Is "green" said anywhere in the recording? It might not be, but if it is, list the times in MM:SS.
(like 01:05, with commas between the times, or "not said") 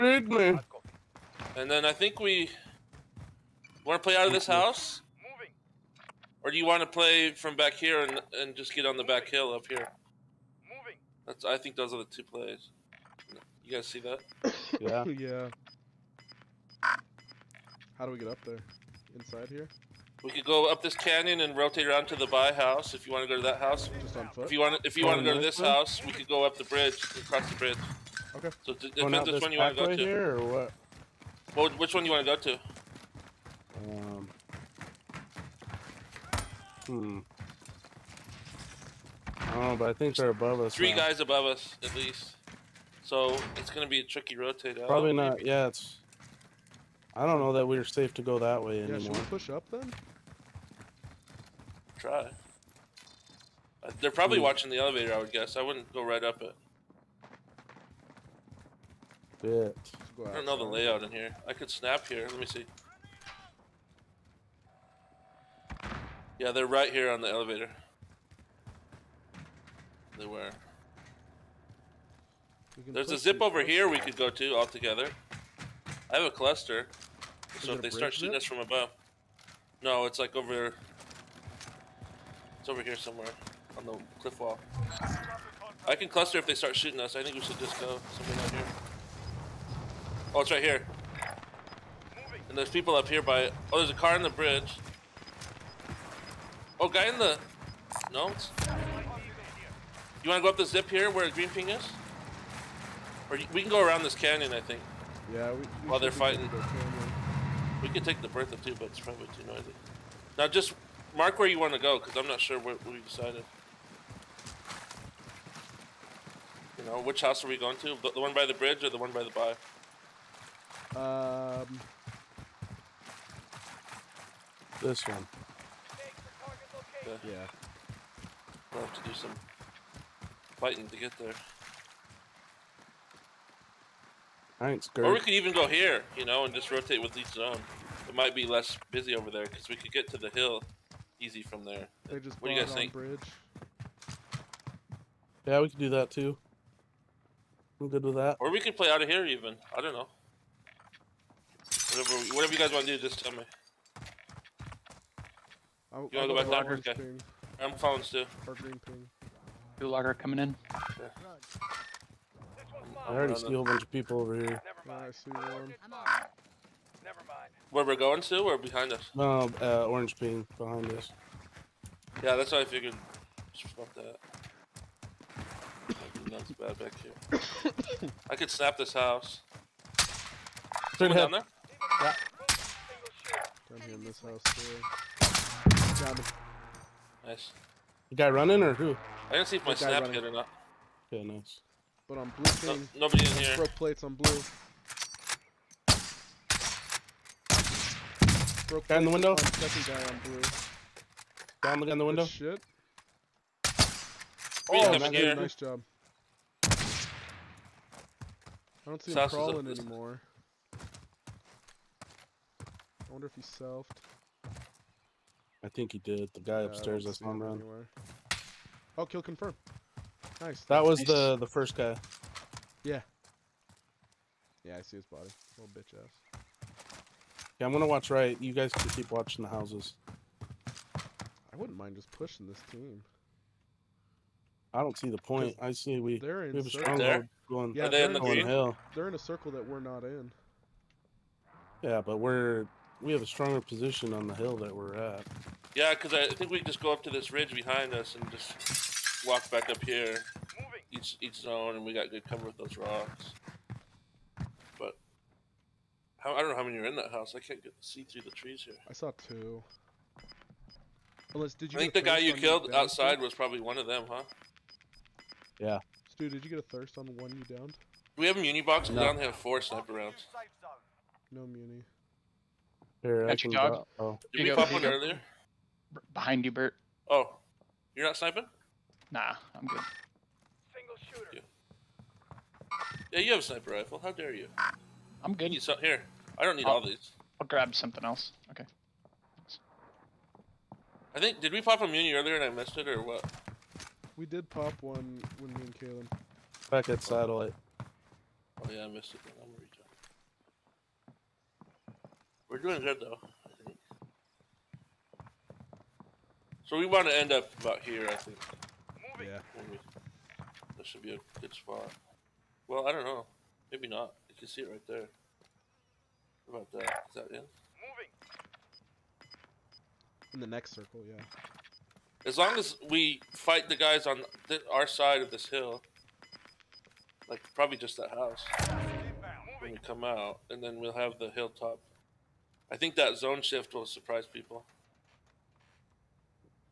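01:41, 02:38.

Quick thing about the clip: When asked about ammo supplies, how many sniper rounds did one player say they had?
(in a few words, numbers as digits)
4.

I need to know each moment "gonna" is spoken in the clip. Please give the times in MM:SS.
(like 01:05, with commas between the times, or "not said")
00:43, 03:47, 04:59.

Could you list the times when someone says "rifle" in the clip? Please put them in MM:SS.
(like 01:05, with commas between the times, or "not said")
04:43.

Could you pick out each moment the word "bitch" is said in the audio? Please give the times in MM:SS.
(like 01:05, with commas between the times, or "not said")
00:59, 03:45.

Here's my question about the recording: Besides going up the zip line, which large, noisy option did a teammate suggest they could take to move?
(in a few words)
The Bertha.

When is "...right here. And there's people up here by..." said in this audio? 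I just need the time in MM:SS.
01:30.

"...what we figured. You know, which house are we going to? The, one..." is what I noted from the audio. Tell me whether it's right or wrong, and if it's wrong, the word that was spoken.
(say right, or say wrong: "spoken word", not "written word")
wrong: "decided", not "figured".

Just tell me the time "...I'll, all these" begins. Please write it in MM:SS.
04:46.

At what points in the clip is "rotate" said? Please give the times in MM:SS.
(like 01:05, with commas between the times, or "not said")
00:21, 00:44, 02:16.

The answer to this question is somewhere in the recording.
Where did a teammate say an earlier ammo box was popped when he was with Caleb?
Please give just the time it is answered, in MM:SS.
04:57.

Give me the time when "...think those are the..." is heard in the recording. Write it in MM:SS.
00:11.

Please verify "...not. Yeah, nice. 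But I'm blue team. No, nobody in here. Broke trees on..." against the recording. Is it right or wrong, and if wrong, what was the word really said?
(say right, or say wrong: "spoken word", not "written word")
wrong: "plates", not "trees".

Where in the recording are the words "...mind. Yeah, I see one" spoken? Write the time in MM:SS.
02:44.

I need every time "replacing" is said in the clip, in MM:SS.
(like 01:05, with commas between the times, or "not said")
not said.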